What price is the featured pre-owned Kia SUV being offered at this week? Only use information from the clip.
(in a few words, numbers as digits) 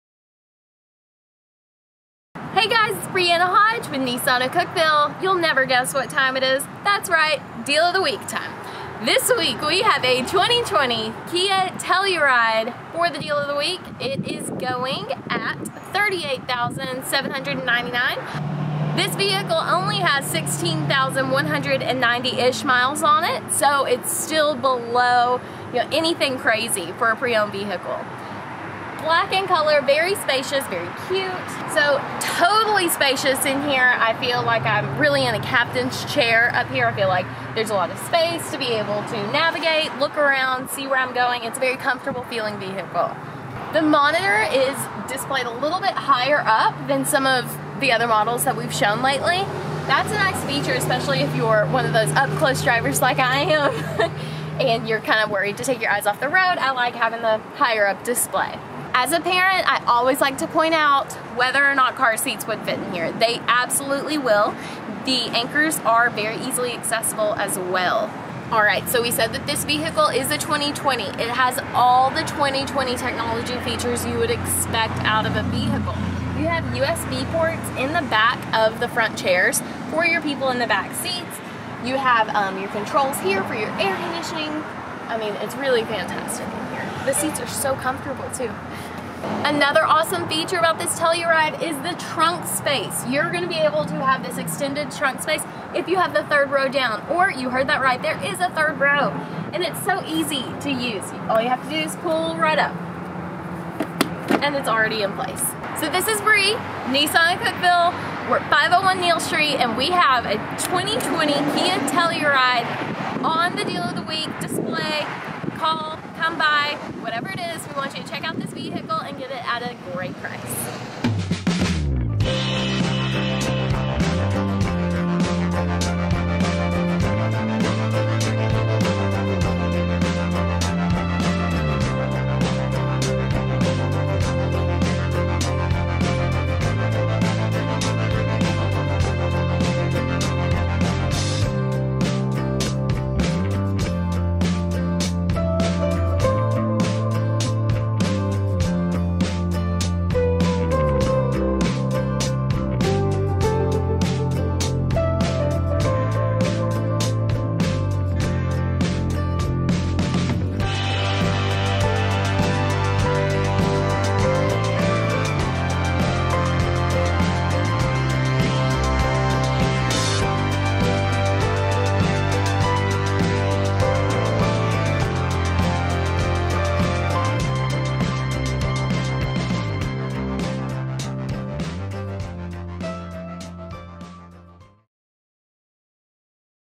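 $38,799.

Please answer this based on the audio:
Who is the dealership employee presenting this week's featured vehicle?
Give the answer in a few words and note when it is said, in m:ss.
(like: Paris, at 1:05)
Brianna Hodge, at 0:03.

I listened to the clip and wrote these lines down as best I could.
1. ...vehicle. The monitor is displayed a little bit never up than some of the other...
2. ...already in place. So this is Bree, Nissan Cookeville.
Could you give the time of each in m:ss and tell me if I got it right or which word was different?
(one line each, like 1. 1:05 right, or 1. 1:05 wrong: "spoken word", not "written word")
1. 0:42 wrong: "higher", not "never"
2. 1:44 right.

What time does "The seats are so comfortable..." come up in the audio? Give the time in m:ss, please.
1:27.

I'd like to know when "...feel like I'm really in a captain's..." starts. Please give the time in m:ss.
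0:34.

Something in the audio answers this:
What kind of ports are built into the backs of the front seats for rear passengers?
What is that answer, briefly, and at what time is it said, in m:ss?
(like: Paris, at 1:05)
USB ports, at 1:16.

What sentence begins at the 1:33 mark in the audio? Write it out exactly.
You're going to be able to have this extended trunk space if you have the third row down.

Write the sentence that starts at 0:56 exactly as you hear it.
I like having the higher up display.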